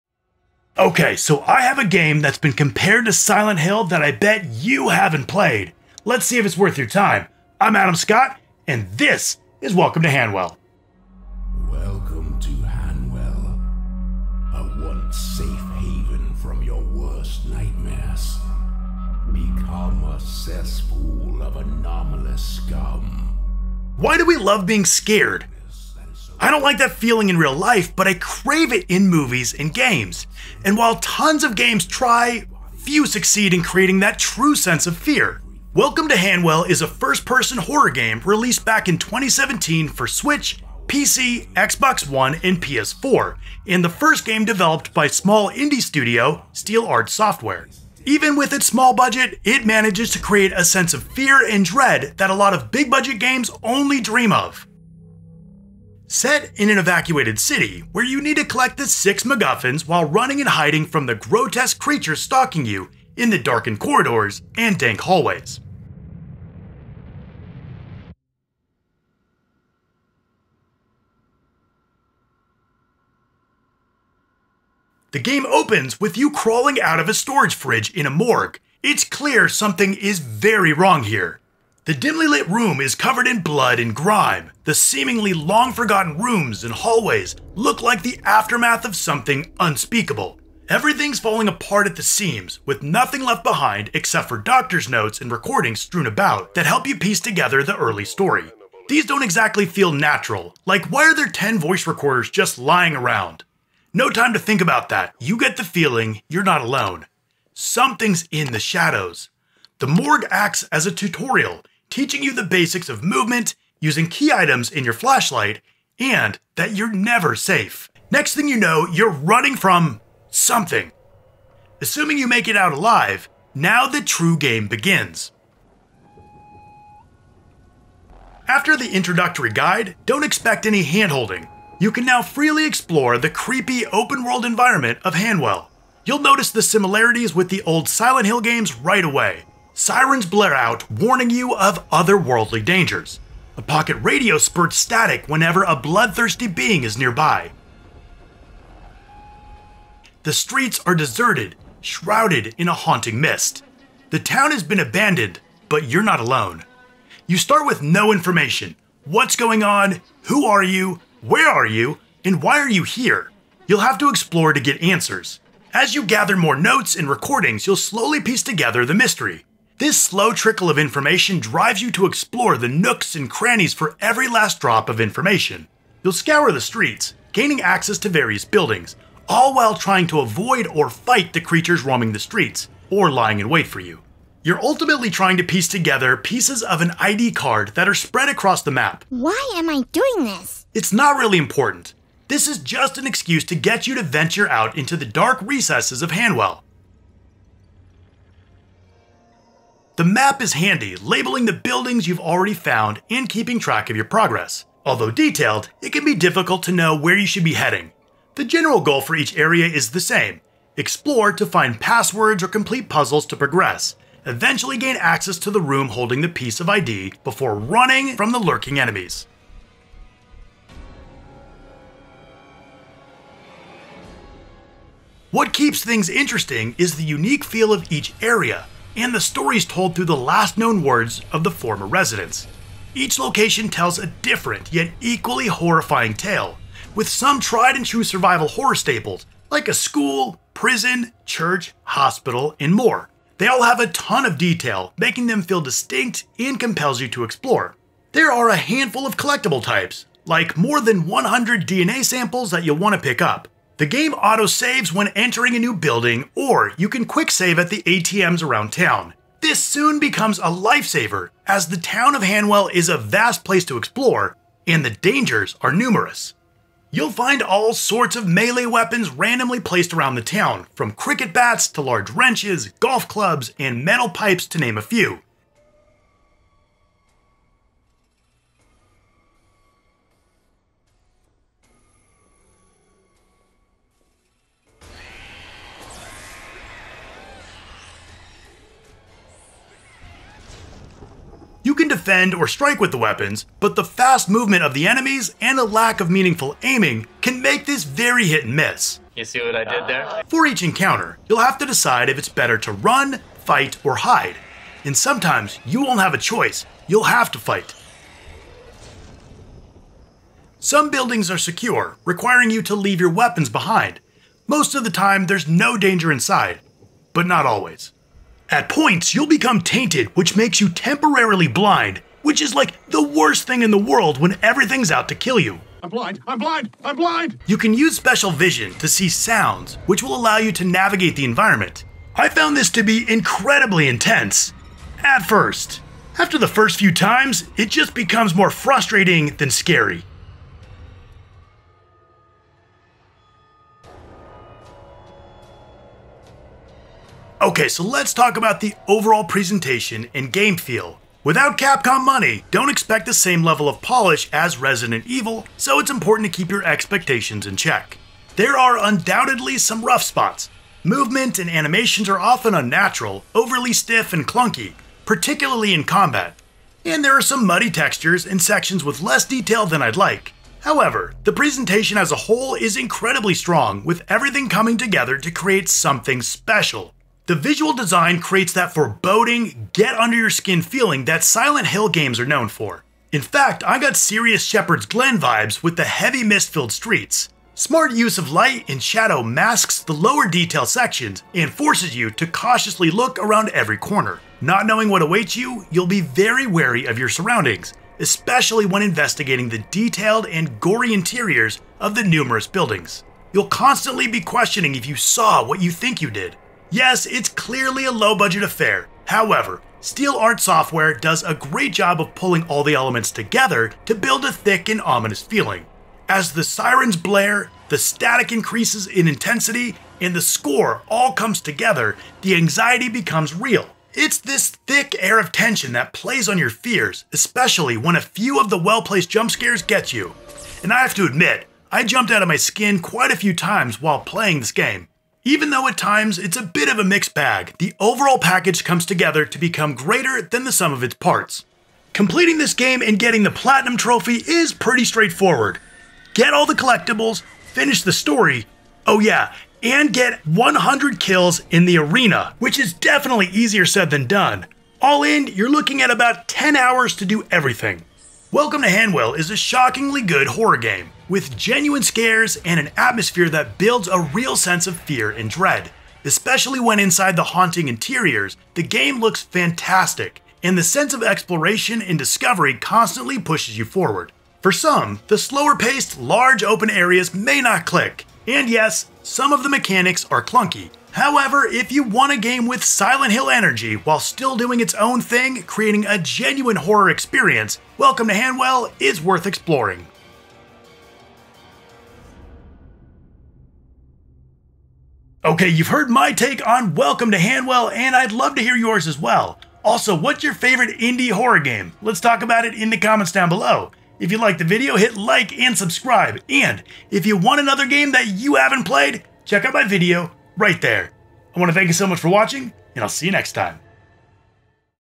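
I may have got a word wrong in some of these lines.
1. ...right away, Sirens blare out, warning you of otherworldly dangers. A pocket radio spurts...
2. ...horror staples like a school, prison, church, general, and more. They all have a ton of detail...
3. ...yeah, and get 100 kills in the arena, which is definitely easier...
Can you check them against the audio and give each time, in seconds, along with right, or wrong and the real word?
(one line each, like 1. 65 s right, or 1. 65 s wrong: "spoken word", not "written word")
1. 138 s right
2. 238 s wrong: "hospital", not "general"
3. 448 s right.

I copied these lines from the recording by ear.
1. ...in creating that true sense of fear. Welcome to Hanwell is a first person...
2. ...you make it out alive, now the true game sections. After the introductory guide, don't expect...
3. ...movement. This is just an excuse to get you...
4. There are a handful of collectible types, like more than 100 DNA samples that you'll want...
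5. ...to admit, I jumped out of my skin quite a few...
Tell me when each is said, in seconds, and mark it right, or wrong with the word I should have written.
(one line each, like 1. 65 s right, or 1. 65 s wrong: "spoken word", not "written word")
1. 33 s right
2. 122 s wrong: "begins", not "sections"
3. 191 s wrong: "important", not "movement"
4. 248 s right
5. 430 s right.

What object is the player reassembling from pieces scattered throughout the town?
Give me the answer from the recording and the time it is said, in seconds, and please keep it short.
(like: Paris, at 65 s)
An ID card, at 186 s.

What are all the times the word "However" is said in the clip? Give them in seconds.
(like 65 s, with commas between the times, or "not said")
370 s, 409 s, 480 s.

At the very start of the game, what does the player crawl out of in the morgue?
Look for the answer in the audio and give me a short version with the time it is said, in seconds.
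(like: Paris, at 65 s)
A storage fridge, at 77 s.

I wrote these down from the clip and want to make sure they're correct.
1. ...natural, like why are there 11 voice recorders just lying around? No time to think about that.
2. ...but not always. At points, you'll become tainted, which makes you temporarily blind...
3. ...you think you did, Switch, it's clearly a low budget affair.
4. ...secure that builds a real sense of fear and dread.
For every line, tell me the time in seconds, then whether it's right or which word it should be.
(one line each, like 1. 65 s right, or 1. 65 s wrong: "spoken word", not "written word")
1. 99 s wrong: "10", not "11"
2. 317 s right
3. 405 s wrong: "Yes", not "Switch"
4. 462 s wrong: "atmosphere", not "secure".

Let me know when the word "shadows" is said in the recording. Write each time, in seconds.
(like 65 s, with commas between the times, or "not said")
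108 s, 388 s.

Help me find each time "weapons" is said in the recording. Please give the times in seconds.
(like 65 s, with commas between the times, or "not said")
268 s, 292 s, 313 s.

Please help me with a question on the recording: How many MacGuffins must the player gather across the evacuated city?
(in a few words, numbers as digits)
6.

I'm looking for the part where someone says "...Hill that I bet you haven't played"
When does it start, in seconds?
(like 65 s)
3 s.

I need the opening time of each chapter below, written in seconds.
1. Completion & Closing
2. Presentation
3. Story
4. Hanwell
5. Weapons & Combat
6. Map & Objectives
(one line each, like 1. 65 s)
1. 442 s
2. 350 s
3. 71 s
4. 127 s
5. 269 s
6. 200 s.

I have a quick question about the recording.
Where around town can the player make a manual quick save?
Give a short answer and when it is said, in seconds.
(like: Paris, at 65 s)
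ATMs, at 257 s.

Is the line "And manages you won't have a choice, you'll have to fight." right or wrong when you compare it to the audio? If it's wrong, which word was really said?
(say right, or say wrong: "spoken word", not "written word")
wrong: "sometimes", not "manages".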